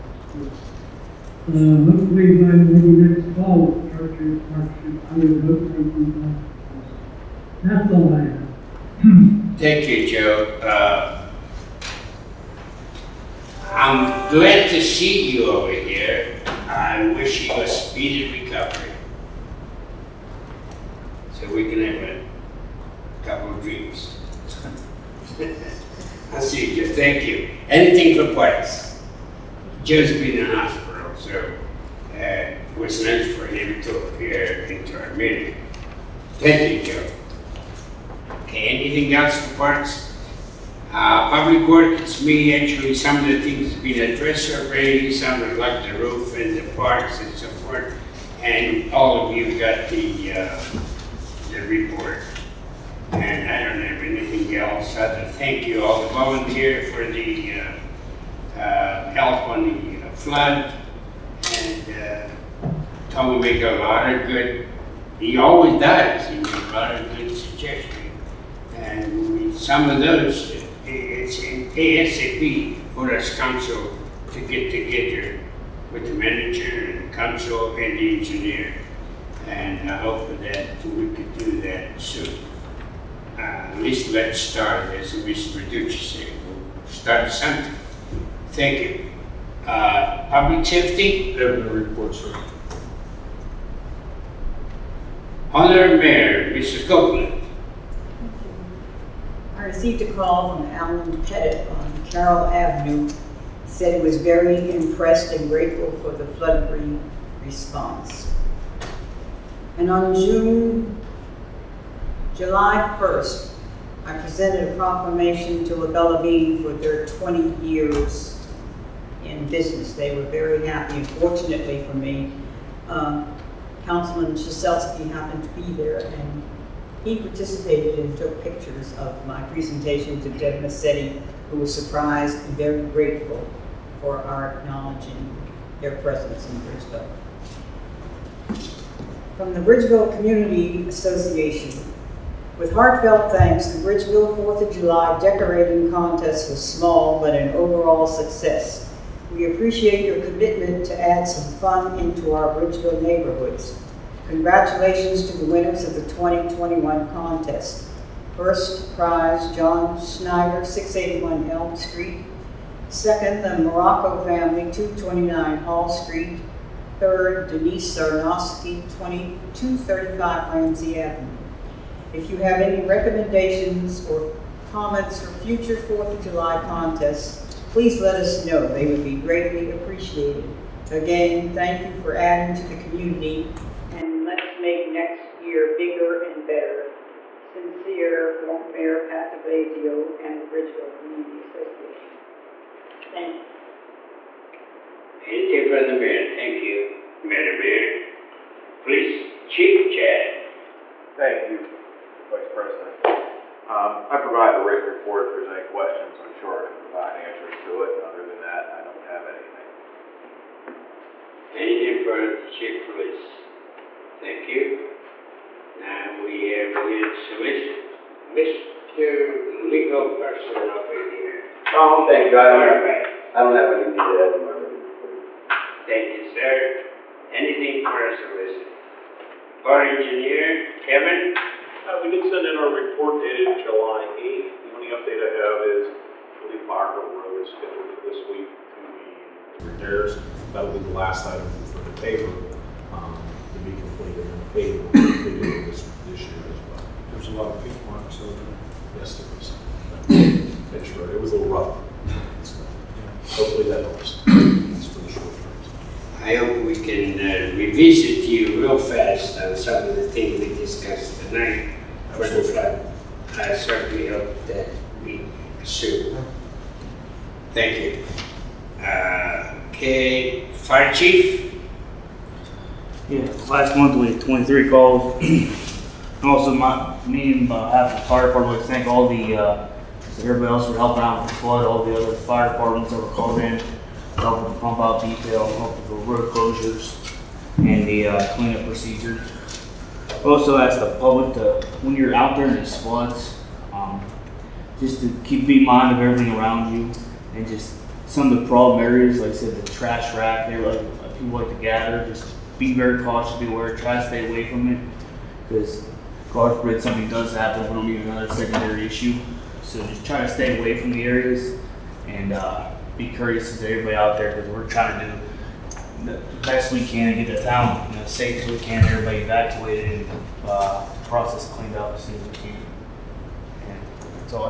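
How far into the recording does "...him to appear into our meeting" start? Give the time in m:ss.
0:33.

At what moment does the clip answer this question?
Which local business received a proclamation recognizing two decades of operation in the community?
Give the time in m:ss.
1:55.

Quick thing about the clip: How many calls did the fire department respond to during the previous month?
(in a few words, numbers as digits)
23.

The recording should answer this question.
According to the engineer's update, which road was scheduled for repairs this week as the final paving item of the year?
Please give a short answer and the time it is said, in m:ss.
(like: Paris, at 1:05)
Margaret Road, at 3:56.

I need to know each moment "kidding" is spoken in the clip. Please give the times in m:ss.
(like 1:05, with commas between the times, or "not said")
not said.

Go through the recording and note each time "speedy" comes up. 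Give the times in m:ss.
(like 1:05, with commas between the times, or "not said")
0:17.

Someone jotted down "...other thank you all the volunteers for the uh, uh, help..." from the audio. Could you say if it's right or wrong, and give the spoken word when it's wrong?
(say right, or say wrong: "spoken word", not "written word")
right.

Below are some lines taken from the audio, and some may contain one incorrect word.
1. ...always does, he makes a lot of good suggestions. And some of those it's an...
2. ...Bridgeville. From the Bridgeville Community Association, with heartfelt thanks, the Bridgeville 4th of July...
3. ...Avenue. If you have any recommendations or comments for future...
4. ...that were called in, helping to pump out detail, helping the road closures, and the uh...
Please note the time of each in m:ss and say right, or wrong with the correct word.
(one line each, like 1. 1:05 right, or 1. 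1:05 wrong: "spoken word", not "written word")
1. 1:05 right
2. 2:16 right
3. 2:50 right
4. 4:42 right.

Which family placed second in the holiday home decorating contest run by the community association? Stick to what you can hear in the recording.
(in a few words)
The Morocco family.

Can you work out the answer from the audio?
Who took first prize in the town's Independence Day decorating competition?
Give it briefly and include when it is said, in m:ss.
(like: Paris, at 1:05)
John Snyder, at 2:39.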